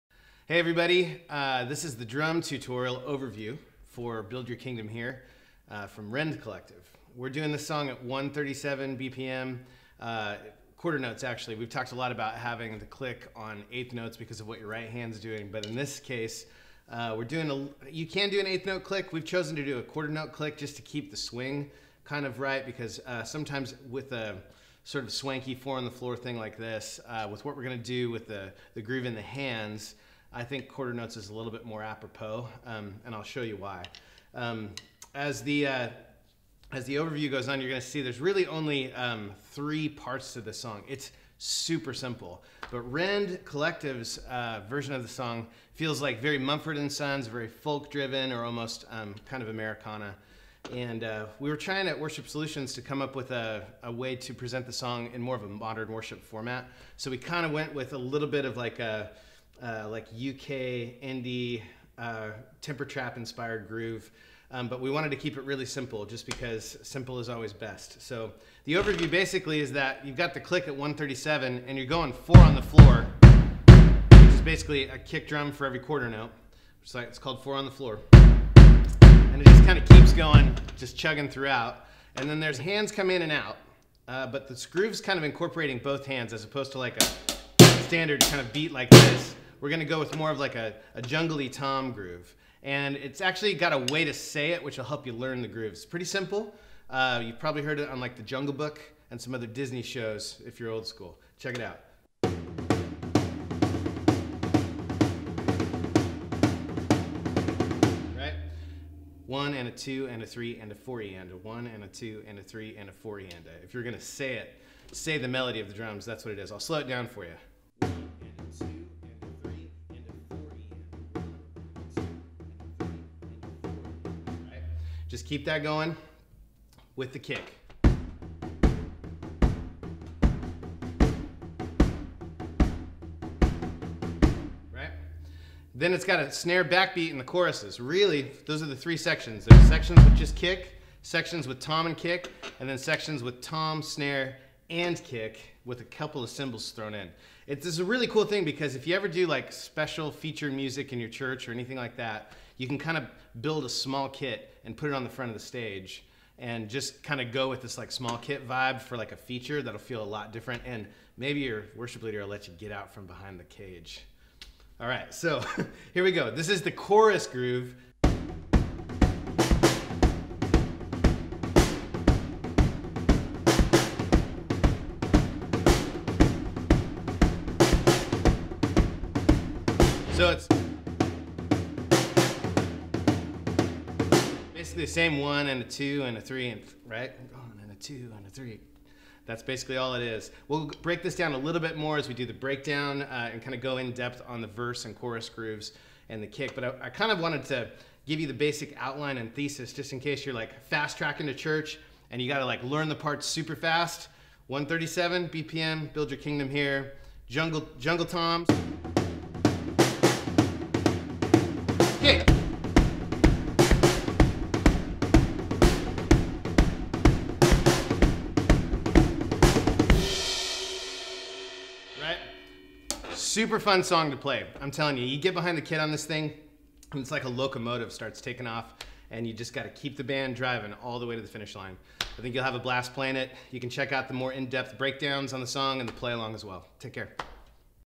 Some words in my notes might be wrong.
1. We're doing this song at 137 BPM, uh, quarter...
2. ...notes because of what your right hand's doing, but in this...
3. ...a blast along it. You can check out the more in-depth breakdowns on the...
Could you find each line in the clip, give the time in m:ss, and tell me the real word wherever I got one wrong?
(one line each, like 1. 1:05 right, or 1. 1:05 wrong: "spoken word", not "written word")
1. 0:07 right
2. 0:13 right
3. 3:52 wrong: "playing", not "along".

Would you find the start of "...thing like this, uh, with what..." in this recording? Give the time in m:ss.
0:26.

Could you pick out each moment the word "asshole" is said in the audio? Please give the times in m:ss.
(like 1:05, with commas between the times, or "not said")
not said.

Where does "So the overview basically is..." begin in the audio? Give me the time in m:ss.
1:08.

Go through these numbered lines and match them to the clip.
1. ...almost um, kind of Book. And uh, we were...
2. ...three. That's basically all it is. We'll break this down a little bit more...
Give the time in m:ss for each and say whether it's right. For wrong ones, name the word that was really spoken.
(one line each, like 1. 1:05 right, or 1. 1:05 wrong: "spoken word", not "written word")
1. 0:48 wrong: "Americana", not "Book"
2. 3:08 right.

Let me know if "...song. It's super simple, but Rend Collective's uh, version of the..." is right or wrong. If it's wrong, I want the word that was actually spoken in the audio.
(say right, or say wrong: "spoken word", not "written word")
right.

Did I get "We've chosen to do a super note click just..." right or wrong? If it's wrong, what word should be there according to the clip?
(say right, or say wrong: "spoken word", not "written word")
wrong: "quarter", not "super".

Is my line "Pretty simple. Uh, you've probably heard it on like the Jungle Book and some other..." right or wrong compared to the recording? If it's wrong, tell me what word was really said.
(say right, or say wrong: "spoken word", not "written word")
right.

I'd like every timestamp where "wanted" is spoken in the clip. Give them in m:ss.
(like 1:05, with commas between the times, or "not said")
1:04, 3:17.